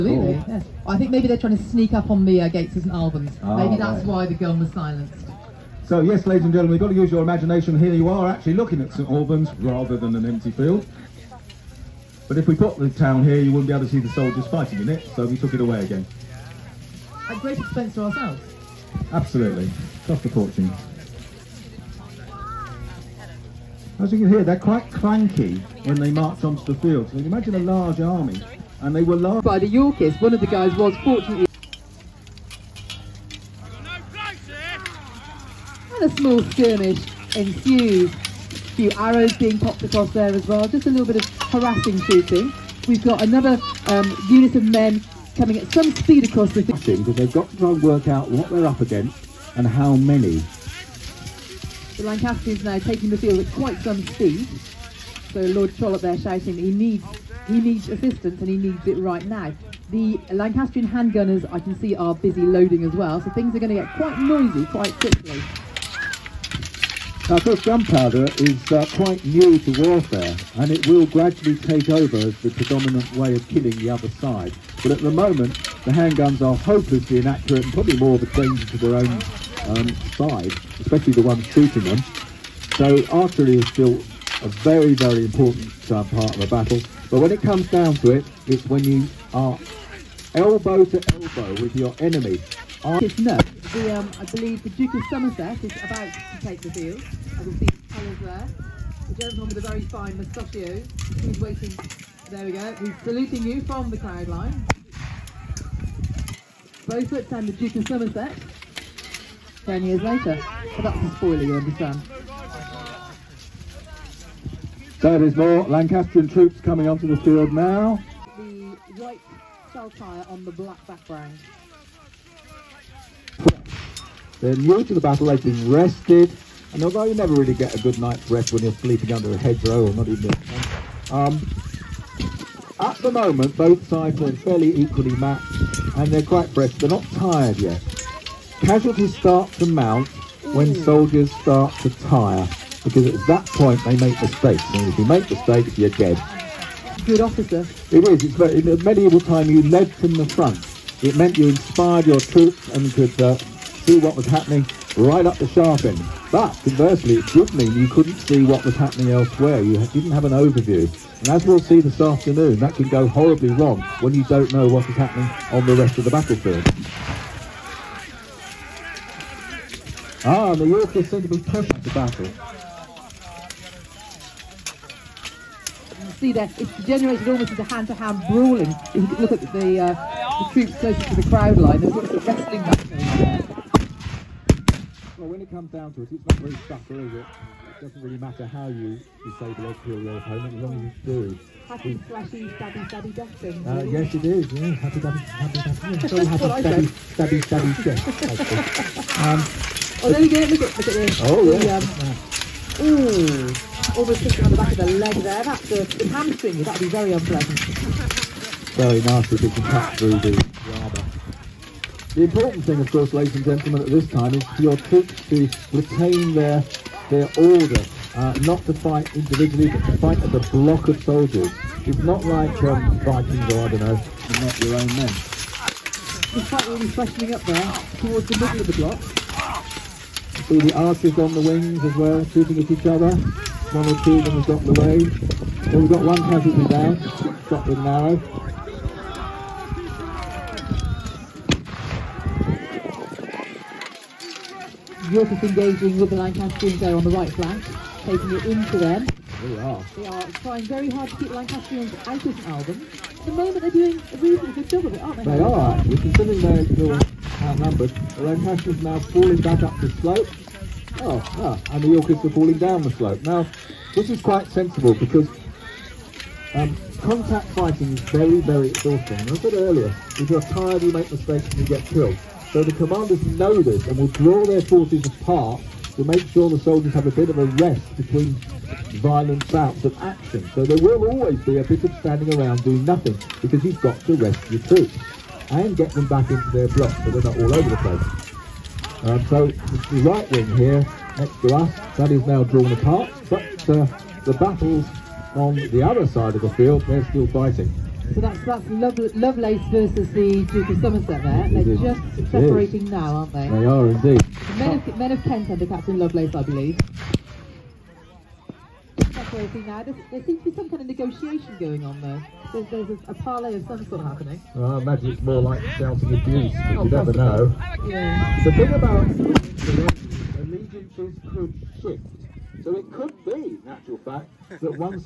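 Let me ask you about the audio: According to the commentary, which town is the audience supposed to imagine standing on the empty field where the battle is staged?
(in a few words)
St Albans.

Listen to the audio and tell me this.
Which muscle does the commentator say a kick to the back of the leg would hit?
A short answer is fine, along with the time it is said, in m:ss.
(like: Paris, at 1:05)
the hamstring, at 3:25.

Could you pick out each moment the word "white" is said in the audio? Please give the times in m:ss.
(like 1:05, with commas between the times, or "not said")
1:59.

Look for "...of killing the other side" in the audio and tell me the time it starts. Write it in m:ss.
1:13.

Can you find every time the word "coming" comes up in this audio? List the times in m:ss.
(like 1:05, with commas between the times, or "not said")
0:45, 1:56.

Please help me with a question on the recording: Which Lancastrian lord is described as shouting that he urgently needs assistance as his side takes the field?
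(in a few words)
Lord Trollope.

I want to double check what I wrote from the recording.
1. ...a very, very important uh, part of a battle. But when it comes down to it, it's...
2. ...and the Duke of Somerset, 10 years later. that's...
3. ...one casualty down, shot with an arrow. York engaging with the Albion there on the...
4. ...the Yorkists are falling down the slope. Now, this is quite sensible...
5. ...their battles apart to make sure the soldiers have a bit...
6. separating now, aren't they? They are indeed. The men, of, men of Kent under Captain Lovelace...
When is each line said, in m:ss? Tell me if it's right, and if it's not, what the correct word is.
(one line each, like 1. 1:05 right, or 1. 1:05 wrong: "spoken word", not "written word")
1. 1:24 right
2. 1:47 right
3. 3:56 wrong: "Lancastrians", not "Albion"
4. 4:21 right
5. 4:34 wrong: "forces", not "battles"
6. 5:02 right.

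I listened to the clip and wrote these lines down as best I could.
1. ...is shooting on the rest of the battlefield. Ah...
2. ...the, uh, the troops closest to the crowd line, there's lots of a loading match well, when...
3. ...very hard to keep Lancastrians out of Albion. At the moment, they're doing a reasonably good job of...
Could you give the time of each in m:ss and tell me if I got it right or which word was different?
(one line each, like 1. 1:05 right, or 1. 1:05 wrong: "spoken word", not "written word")
1. 2:44 wrong: "happening", not "shooting"
2. 2:59 wrong: "wrestling", not "loading"
3. 4:10 right.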